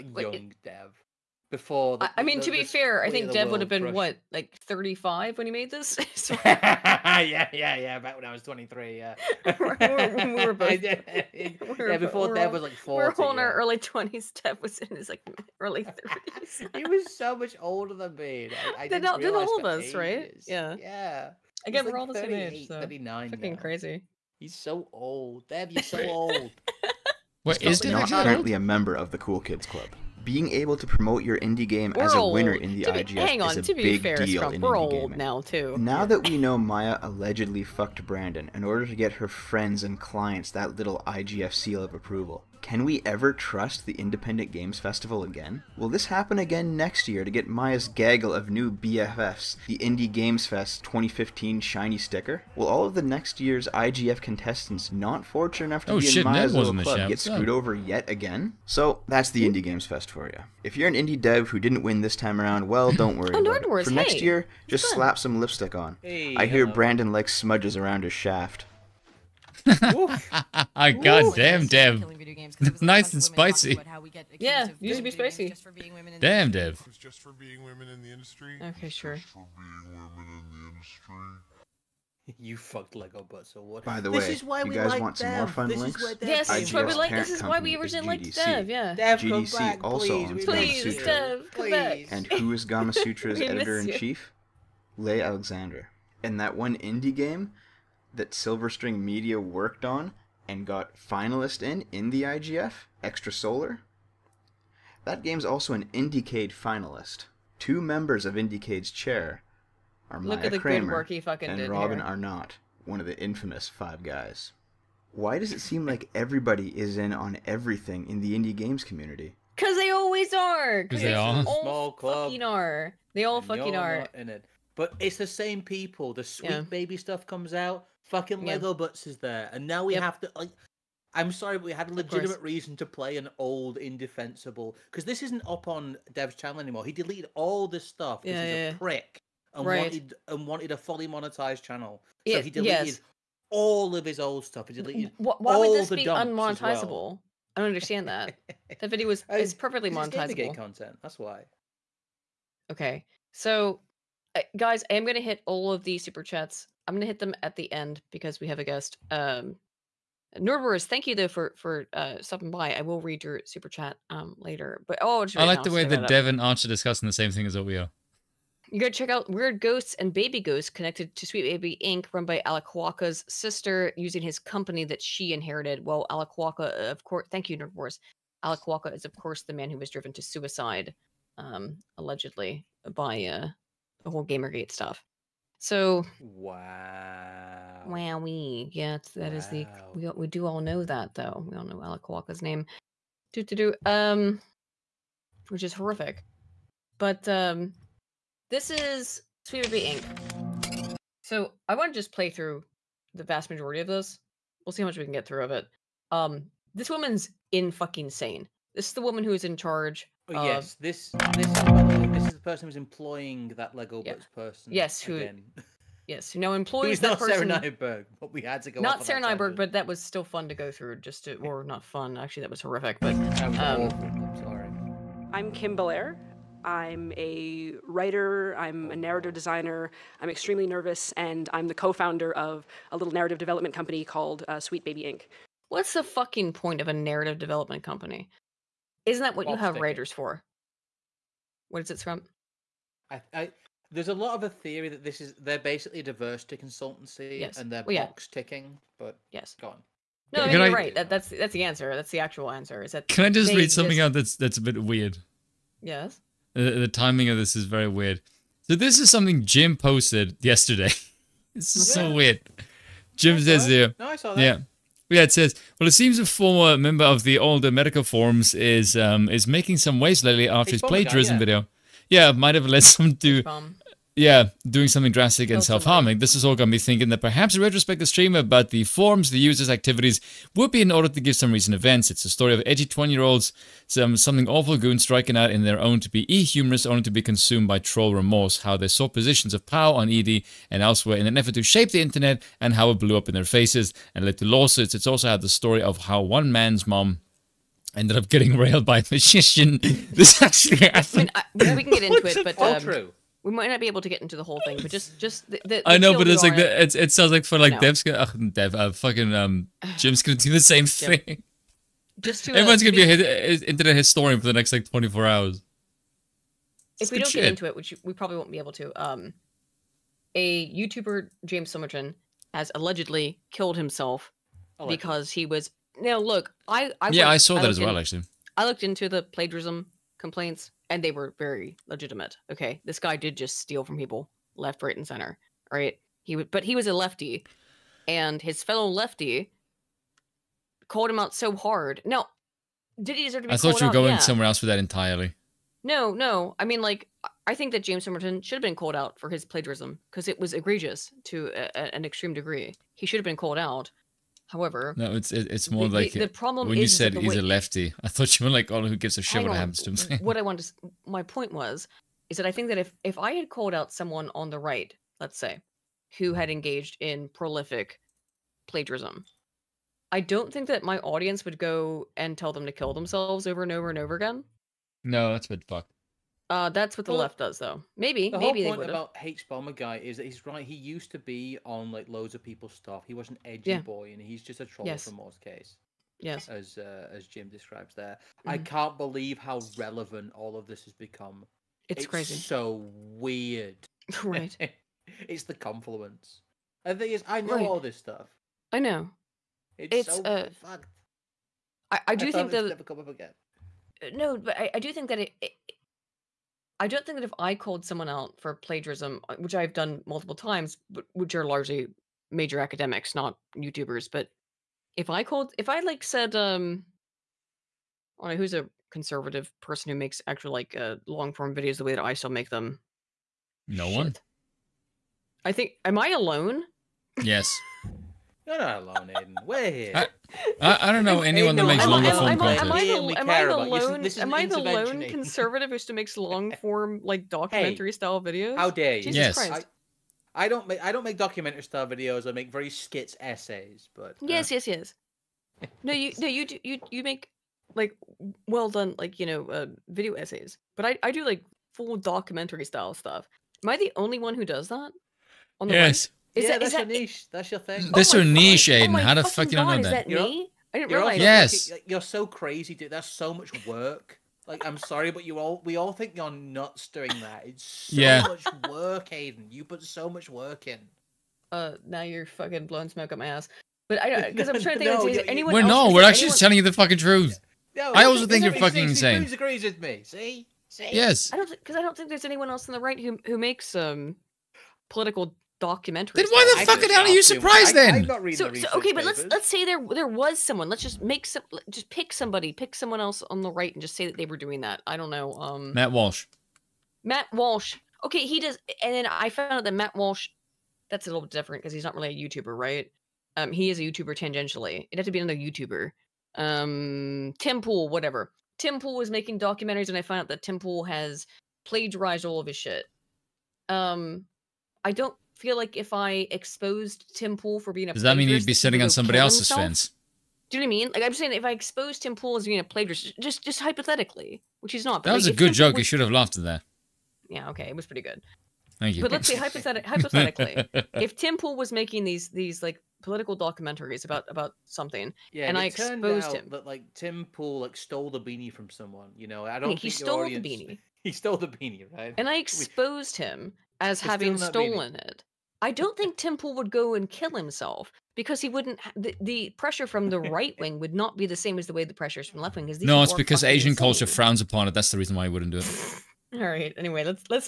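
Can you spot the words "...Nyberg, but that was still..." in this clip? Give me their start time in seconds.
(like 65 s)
219 s.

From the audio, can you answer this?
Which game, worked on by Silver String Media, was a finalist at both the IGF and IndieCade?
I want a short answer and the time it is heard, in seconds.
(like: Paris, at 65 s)
Extrasolar, at 103 s.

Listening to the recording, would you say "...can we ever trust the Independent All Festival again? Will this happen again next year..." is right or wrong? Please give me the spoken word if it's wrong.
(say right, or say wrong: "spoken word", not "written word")
wrong: "Games", not "All".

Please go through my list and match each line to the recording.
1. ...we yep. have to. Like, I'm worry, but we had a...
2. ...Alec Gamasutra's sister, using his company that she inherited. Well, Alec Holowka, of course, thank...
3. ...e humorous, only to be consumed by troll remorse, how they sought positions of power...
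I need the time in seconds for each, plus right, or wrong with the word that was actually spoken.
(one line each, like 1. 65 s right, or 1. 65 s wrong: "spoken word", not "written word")
1. 129 s wrong: "sorry", not "worry"
2. 172 s wrong: "Holowka", not "Gamasutra"
3. 286 s right.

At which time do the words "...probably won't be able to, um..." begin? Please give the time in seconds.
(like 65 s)
318 s.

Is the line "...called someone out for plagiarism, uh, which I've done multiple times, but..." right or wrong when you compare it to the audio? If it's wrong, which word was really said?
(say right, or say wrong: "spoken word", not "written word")
right.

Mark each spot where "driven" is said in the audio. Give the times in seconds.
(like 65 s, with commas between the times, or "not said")
179 s.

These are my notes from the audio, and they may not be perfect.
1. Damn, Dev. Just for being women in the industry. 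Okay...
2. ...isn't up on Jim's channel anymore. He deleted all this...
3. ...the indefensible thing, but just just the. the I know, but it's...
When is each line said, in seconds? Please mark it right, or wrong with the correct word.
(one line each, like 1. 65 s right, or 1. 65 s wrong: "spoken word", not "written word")
1. 76 s right
2. 135 s wrong: "Dev", not "Jim"
3. 304 s wrong: "whole", not "indefensible".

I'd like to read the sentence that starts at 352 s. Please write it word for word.
He should have been called out.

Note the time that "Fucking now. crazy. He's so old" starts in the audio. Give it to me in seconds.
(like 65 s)
23 s.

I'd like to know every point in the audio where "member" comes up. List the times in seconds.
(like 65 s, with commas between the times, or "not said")
28 s, 107 s, 266 s.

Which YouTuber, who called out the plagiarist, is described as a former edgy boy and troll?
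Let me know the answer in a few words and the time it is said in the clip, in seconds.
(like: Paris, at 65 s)
Hbomberguy, at 379 s.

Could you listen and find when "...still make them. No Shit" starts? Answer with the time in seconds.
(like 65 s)
422 s.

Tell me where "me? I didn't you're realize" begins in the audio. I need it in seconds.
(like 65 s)
460 s.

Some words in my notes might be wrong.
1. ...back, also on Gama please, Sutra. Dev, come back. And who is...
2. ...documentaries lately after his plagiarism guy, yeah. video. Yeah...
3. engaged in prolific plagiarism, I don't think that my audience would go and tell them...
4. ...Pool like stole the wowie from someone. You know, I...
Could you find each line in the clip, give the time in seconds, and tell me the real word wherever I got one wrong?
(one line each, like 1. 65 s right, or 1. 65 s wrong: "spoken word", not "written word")
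1. 89 s right
2. 270 s wrong: "waves", not "documentaries"
3. 366 s right
4. 537 s wrong: "beanie", not "wowie".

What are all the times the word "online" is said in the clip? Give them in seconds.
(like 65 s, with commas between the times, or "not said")
not said.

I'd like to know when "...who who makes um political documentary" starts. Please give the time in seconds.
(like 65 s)
482 s.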